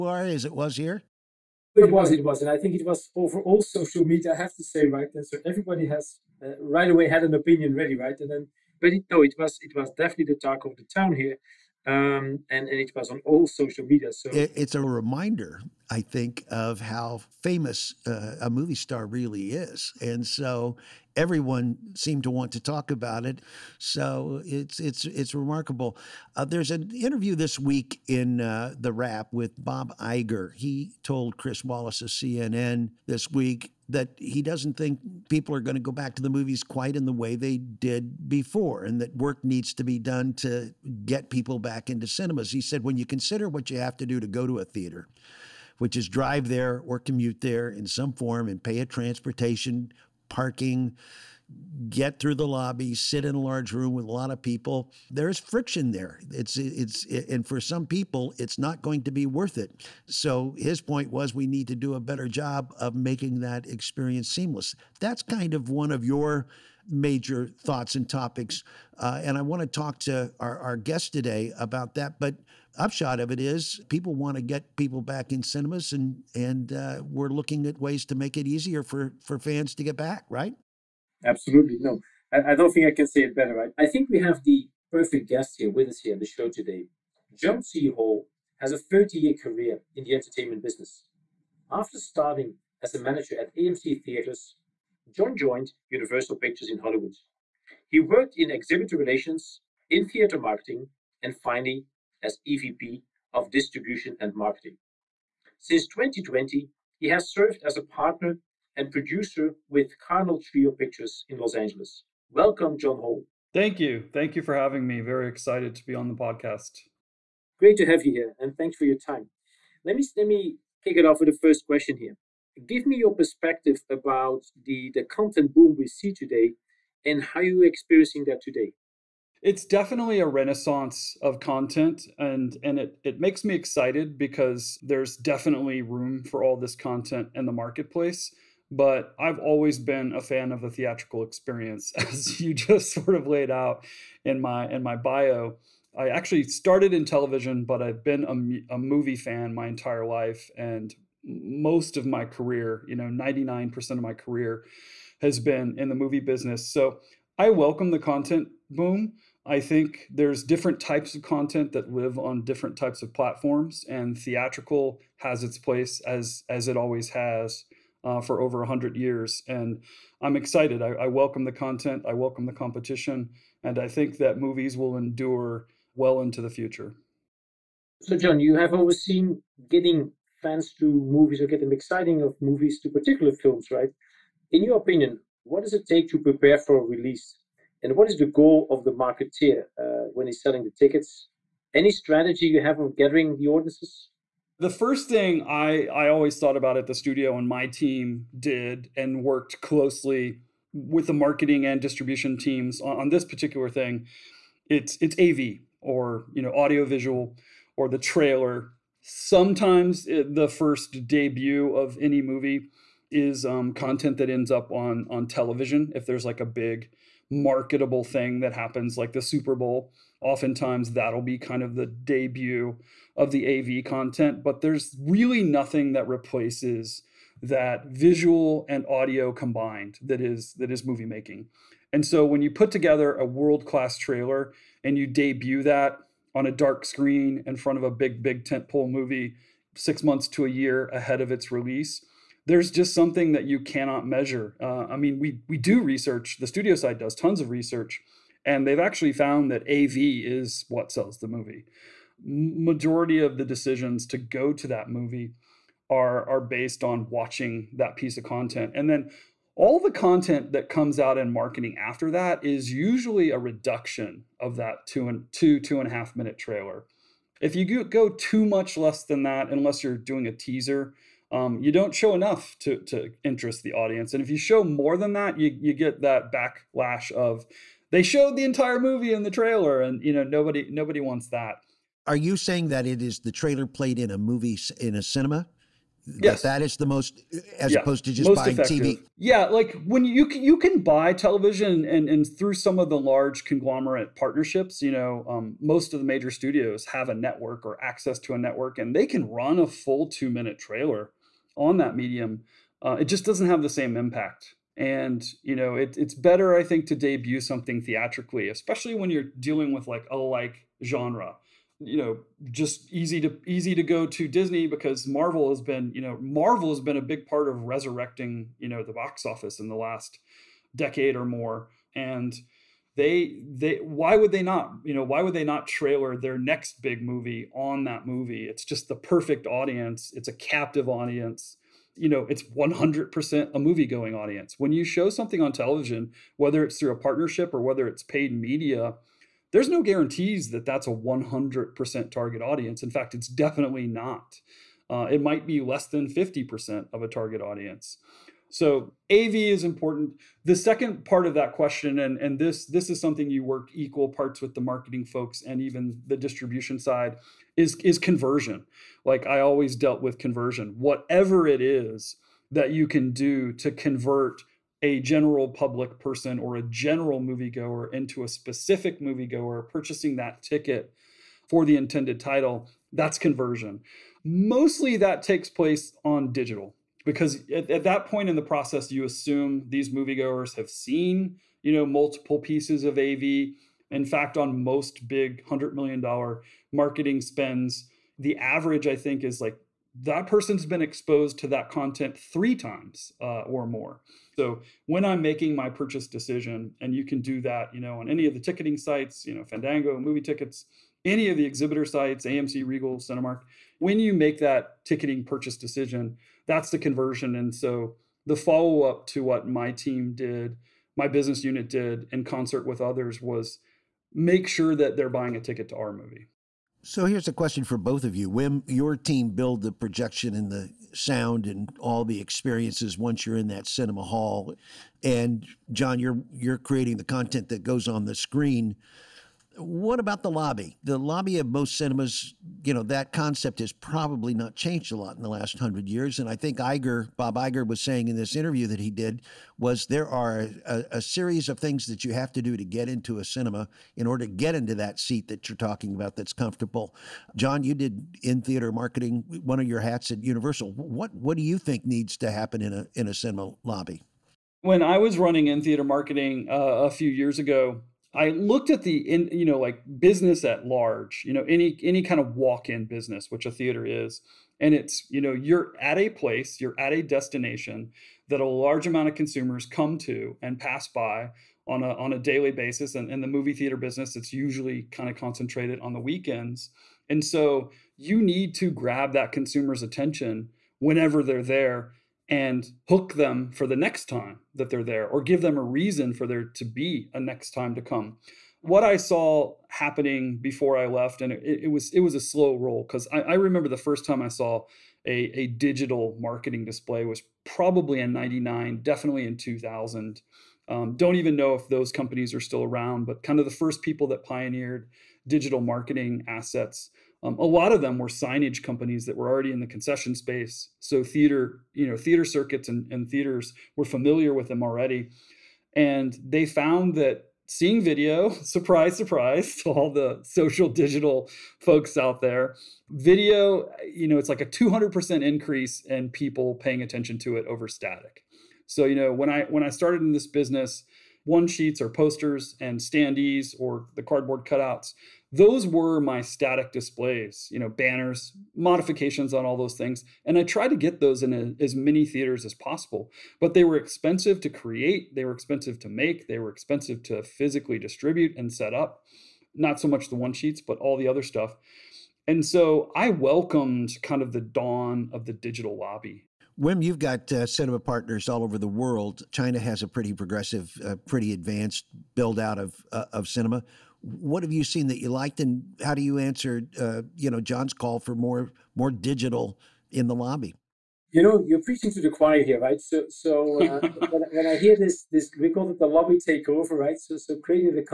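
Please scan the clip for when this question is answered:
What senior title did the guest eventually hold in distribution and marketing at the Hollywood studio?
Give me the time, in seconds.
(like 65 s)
102 s.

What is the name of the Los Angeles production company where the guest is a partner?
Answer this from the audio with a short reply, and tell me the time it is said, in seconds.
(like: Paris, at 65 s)
Cardinal Trio Pictures, at 110 s.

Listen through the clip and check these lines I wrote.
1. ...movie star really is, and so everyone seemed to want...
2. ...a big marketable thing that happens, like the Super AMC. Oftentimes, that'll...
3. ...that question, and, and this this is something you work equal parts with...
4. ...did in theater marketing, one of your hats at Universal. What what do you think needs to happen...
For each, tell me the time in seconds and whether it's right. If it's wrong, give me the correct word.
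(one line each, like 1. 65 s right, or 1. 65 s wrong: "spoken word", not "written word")
1. 18 s right
2. 216 s wrong: "Bowl", not "AMC"
3. 351 s right
4. 447 s right.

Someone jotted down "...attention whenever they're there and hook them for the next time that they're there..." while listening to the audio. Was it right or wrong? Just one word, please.
right.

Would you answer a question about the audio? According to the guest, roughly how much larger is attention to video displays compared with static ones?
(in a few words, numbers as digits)
200%.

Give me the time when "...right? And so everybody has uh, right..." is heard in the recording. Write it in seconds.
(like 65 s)
4 s.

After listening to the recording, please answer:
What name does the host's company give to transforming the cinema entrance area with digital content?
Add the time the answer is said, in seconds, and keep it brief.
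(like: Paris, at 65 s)
lobby takeover, at 575 s.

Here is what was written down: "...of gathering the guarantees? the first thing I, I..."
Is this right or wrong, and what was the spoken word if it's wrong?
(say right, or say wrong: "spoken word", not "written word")
wrong: "audiences", not "guarantees".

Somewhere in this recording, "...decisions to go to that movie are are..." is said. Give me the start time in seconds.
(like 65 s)
253 s.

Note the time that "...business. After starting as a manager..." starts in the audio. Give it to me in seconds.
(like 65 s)
90 s.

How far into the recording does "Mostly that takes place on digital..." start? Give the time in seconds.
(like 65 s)
374 s.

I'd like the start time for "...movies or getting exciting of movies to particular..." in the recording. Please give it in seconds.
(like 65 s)
180 s.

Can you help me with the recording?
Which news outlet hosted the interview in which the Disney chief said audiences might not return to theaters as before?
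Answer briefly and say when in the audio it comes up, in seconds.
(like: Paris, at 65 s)
CNN, at 32 s.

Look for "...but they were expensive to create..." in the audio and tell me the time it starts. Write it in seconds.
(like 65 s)
543 s.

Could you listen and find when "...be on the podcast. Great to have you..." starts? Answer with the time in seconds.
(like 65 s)
115 s.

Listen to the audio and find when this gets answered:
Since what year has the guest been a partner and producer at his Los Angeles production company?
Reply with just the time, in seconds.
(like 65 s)
105 s.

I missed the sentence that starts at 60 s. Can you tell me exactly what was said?
So his point was we need to do a better job of making that experience seamless.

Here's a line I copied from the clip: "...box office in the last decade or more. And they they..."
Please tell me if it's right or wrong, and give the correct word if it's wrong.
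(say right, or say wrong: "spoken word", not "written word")
right.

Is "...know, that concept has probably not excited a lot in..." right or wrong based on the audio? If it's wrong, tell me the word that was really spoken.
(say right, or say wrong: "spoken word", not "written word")
wrong: "changed", not "excited".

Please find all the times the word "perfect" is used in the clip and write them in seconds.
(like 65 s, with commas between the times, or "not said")
84 s, 328 s.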